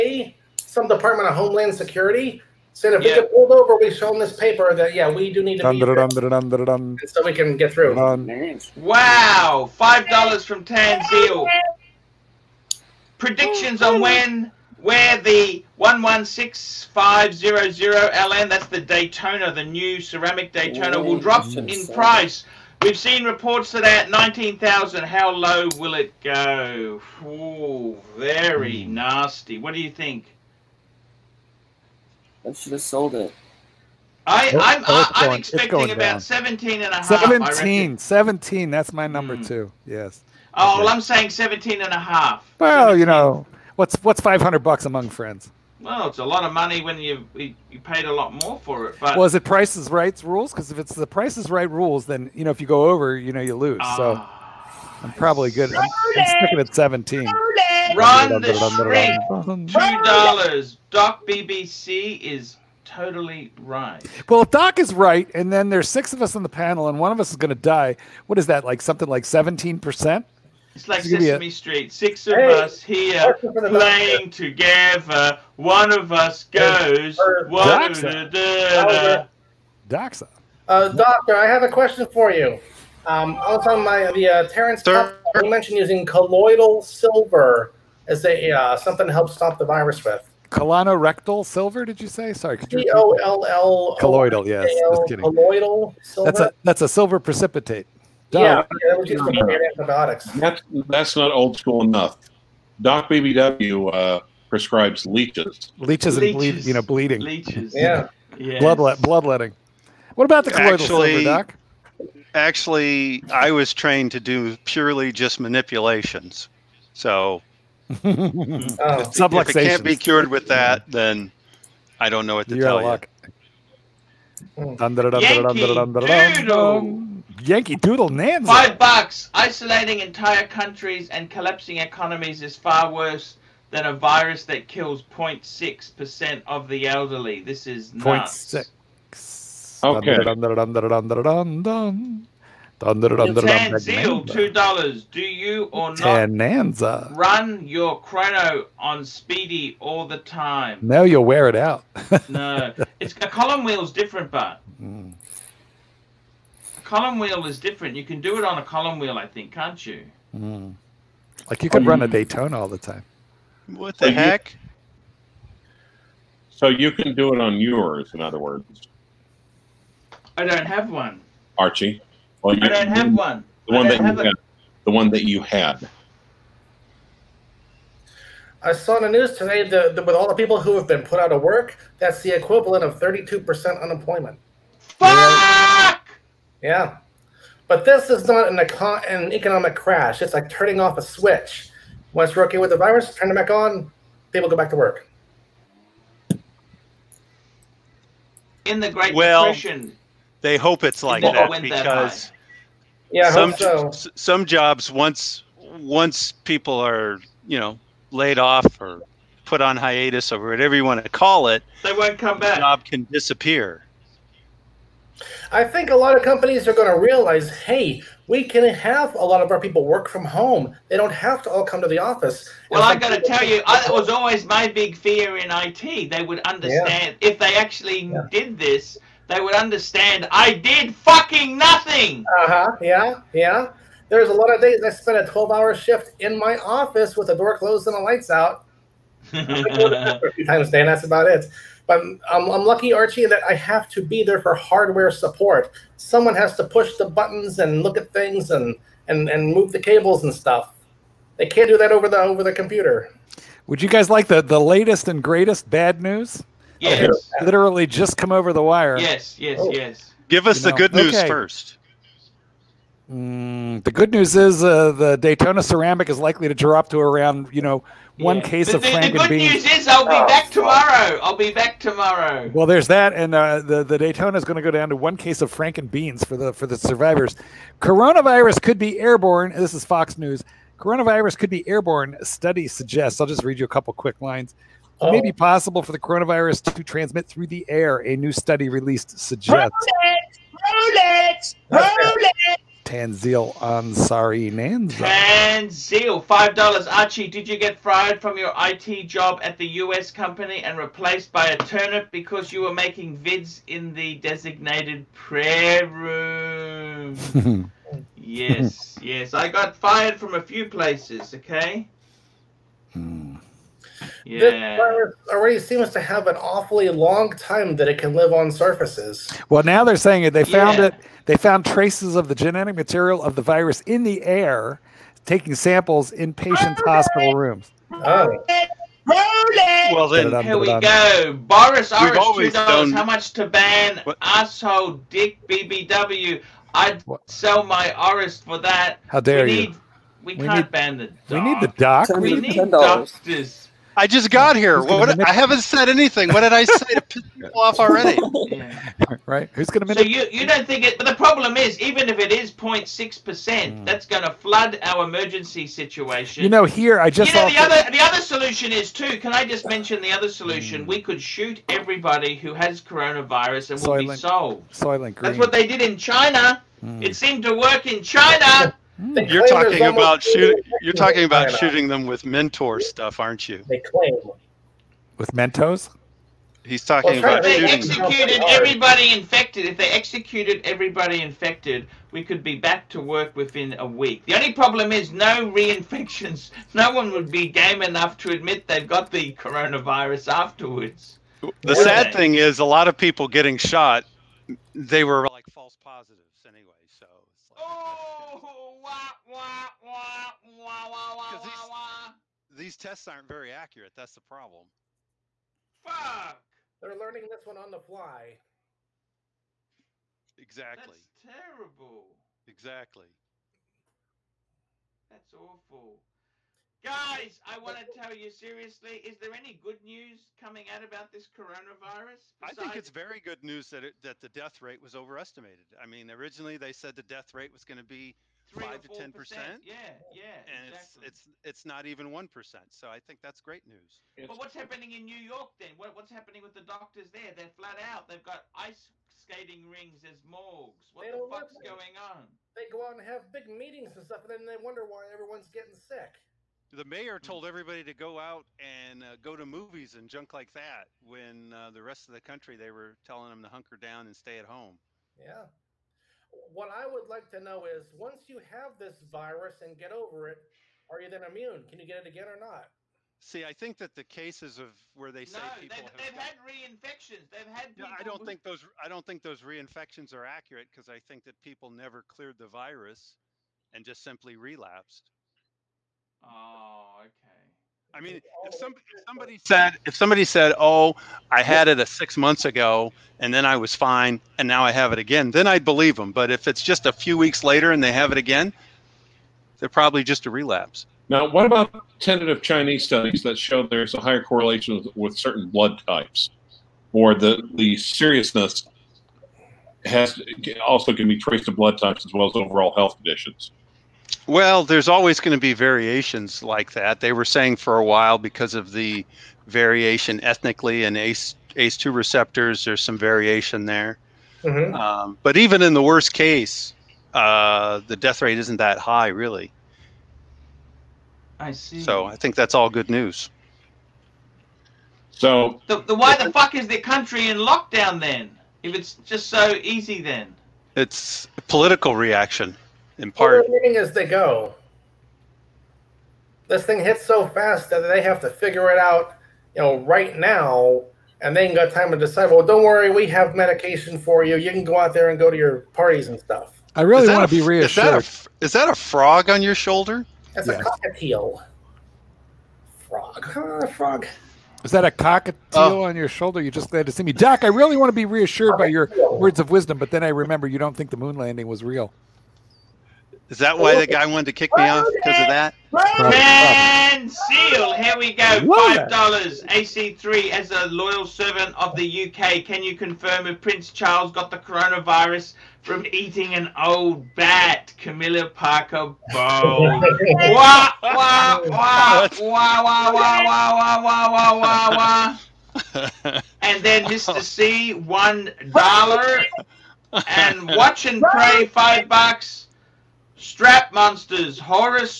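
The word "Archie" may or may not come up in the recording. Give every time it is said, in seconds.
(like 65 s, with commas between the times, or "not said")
171 s, 242 s, 296 s.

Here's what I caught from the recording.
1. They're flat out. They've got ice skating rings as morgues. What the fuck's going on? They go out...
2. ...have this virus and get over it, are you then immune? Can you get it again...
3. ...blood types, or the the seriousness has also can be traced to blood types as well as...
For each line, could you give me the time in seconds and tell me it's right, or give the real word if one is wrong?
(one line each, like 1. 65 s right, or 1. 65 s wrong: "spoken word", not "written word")
1. 437 s right
2. 458 s right
3. 495 s right.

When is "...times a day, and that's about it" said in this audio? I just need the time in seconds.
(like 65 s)
240 s.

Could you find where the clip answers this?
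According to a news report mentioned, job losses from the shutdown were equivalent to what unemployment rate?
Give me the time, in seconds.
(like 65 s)
182 s.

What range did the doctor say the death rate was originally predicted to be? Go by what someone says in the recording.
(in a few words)
5 to 10 percent.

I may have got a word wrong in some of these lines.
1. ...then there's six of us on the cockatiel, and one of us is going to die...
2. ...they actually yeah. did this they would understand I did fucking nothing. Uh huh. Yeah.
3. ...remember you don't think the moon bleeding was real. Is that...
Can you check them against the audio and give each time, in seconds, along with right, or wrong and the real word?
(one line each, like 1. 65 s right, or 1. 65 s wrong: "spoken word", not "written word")
1. 65 s wrong: "panel", not "cockatiel"
2. 227 s right
3. 560 s wrong: "landing", not "bleeding".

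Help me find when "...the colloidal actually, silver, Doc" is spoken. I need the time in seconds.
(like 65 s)
110 s.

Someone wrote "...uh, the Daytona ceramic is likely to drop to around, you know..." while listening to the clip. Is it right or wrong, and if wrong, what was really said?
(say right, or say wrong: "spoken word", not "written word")
right.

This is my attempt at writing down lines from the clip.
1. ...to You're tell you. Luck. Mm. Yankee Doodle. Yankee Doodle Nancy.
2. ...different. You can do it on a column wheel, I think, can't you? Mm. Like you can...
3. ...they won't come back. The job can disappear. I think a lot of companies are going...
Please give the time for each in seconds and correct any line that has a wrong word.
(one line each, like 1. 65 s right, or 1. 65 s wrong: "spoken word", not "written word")
1. 122 s right
2. 157 s right
3. 211 s right.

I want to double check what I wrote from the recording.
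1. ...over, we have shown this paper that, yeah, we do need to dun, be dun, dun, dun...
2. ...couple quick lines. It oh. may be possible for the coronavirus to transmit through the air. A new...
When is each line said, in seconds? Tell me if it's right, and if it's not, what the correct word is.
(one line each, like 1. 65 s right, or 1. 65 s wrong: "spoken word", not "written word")
1. 3 s right
2. 283 s right.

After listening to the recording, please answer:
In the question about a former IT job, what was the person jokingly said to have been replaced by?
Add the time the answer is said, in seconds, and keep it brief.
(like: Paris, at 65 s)
a turnip, at 301 s.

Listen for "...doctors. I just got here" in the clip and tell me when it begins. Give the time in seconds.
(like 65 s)
342 s.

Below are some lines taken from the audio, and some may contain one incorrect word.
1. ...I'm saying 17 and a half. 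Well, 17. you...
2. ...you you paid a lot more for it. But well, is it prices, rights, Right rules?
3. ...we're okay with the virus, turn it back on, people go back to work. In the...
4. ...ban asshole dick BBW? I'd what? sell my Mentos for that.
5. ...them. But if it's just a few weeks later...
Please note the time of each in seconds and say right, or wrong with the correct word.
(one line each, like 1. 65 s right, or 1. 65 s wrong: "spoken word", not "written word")
1. 40 s right
2. 46 s right
3. 192 s right
4. 333 s wrong: "Aris", not "Mentos"
5. 485 s right.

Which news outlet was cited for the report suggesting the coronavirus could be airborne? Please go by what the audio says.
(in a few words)
Fox News.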